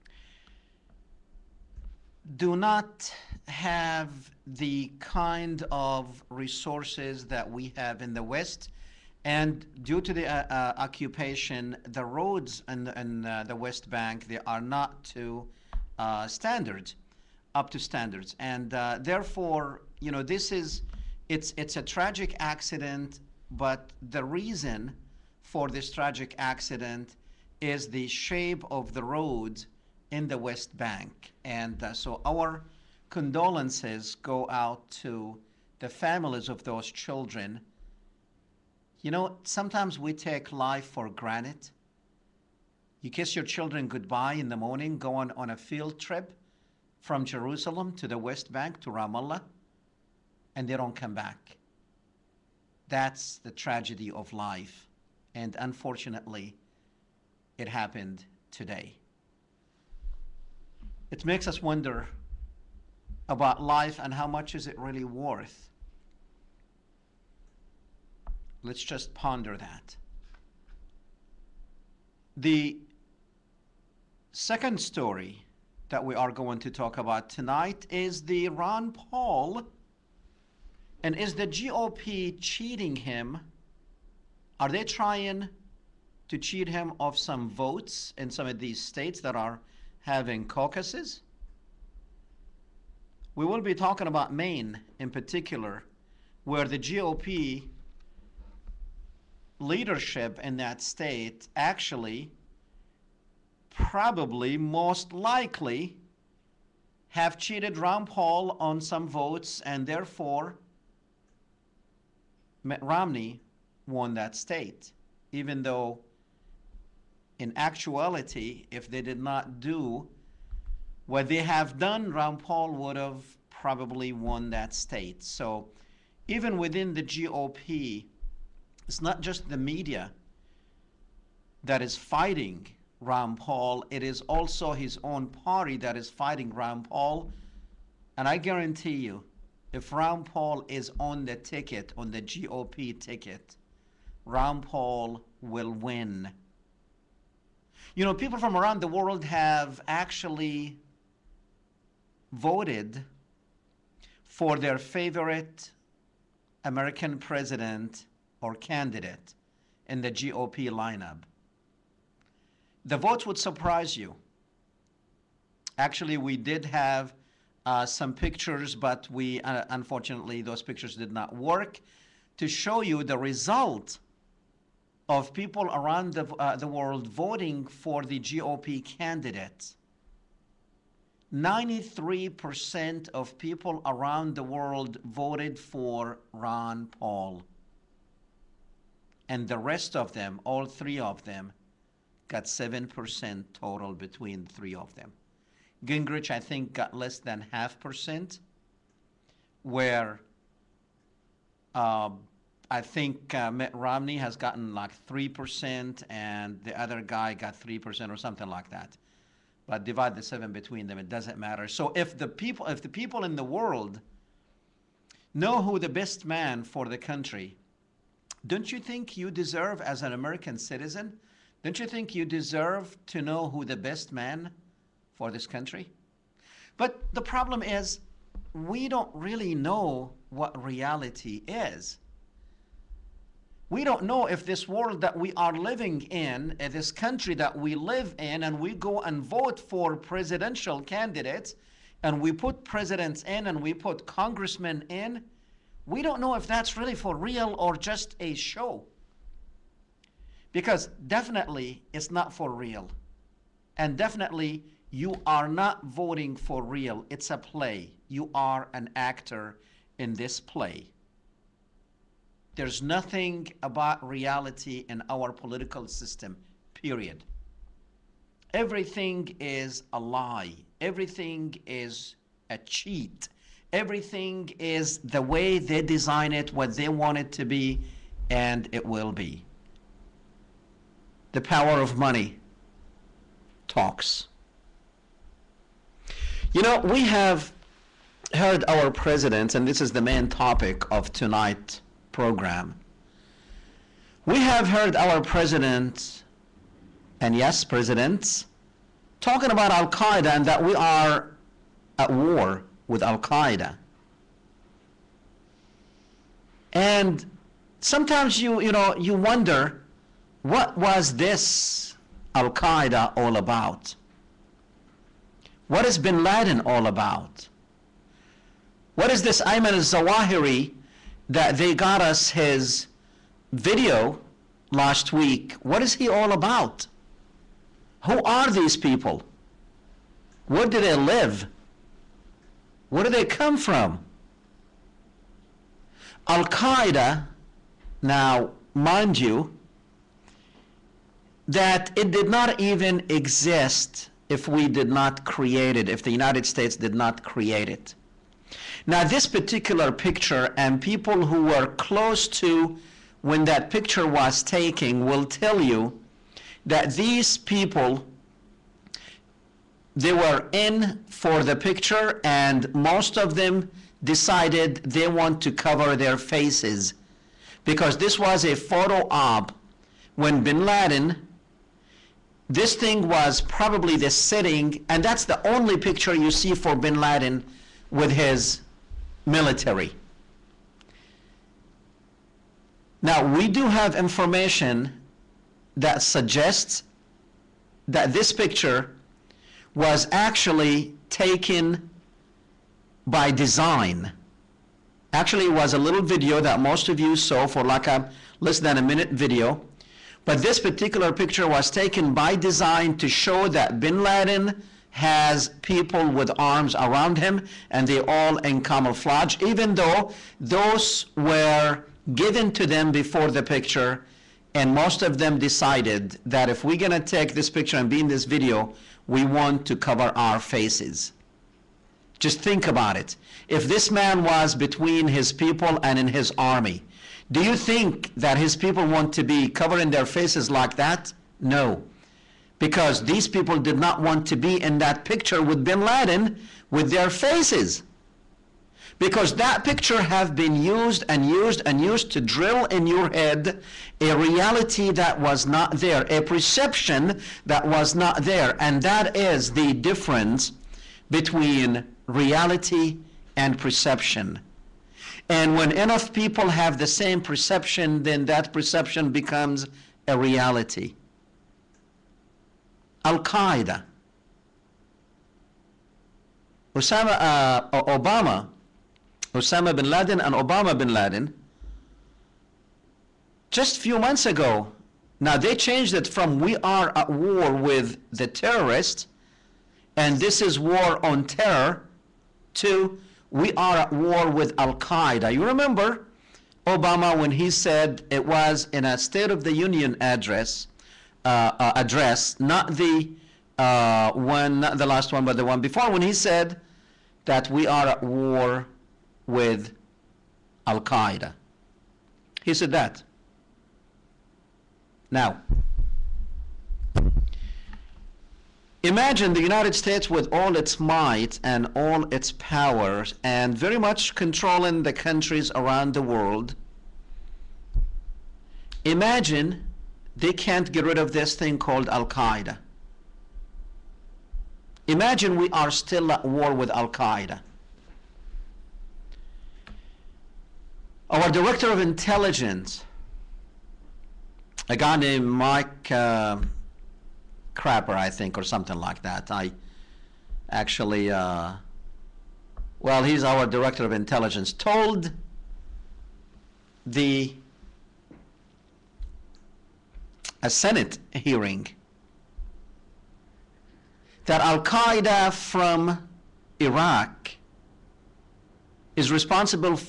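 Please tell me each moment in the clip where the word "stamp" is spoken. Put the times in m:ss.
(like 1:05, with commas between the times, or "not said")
not said.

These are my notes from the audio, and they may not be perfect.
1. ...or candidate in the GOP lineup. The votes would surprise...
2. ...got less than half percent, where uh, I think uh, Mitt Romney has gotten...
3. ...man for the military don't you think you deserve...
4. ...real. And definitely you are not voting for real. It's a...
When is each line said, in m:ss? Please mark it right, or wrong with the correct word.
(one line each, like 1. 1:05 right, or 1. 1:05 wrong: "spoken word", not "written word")
1. 2:38 right
2. 3:16 right
3. 3:36 wrong: "country", not "military"
4. 4:12 right.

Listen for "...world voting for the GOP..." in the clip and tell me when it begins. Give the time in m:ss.
2:56.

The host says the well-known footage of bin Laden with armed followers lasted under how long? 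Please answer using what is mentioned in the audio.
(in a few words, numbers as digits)
a minute.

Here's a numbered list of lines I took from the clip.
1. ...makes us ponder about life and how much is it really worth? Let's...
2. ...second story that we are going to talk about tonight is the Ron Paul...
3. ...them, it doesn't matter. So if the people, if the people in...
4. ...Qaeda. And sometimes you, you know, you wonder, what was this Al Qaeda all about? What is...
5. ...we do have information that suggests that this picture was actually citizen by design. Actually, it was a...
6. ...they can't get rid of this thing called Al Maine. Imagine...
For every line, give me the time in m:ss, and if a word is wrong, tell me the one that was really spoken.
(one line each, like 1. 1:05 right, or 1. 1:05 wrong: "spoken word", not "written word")
1. 1:01 wrong: "wonder", not "ponder"
2. 1:14 right
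3. 3:30 right
4. 5:03 right
5. 6:23 wrong: "taken", not "citizen"
6. 8:40 wrong: "Qaeda", not "Maine".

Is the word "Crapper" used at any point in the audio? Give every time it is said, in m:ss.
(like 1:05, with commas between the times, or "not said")
8:57.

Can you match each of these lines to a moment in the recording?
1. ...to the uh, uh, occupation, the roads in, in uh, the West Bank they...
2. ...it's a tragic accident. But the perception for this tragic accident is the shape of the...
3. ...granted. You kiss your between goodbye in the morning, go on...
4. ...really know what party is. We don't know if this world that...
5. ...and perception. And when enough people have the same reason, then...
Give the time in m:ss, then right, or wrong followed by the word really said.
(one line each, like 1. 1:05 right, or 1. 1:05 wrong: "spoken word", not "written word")
1. 0:09 right
2. 0:21 wrong: "reason", not "perception"
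3. 0:41 wrong: "children", not "between"
4. 3:49 wrong: "reality", not "party"
5. 7:33 wrong: "perception", not "reason".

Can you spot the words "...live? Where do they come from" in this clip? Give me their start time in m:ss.
5:30.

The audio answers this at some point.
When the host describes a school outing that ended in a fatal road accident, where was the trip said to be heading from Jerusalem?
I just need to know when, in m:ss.
0:48.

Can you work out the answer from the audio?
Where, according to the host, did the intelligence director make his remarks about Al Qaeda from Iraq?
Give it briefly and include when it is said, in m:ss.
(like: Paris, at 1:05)
a Senate hearing, at 9:10.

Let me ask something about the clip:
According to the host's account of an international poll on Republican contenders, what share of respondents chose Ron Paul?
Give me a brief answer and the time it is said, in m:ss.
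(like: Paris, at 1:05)
93%, at 3:01.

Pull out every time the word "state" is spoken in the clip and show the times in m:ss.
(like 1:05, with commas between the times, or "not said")
1:28, 1:40, 1:54, 2:04, 5:46, 8:08, 8:29.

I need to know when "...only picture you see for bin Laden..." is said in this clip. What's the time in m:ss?
6:15.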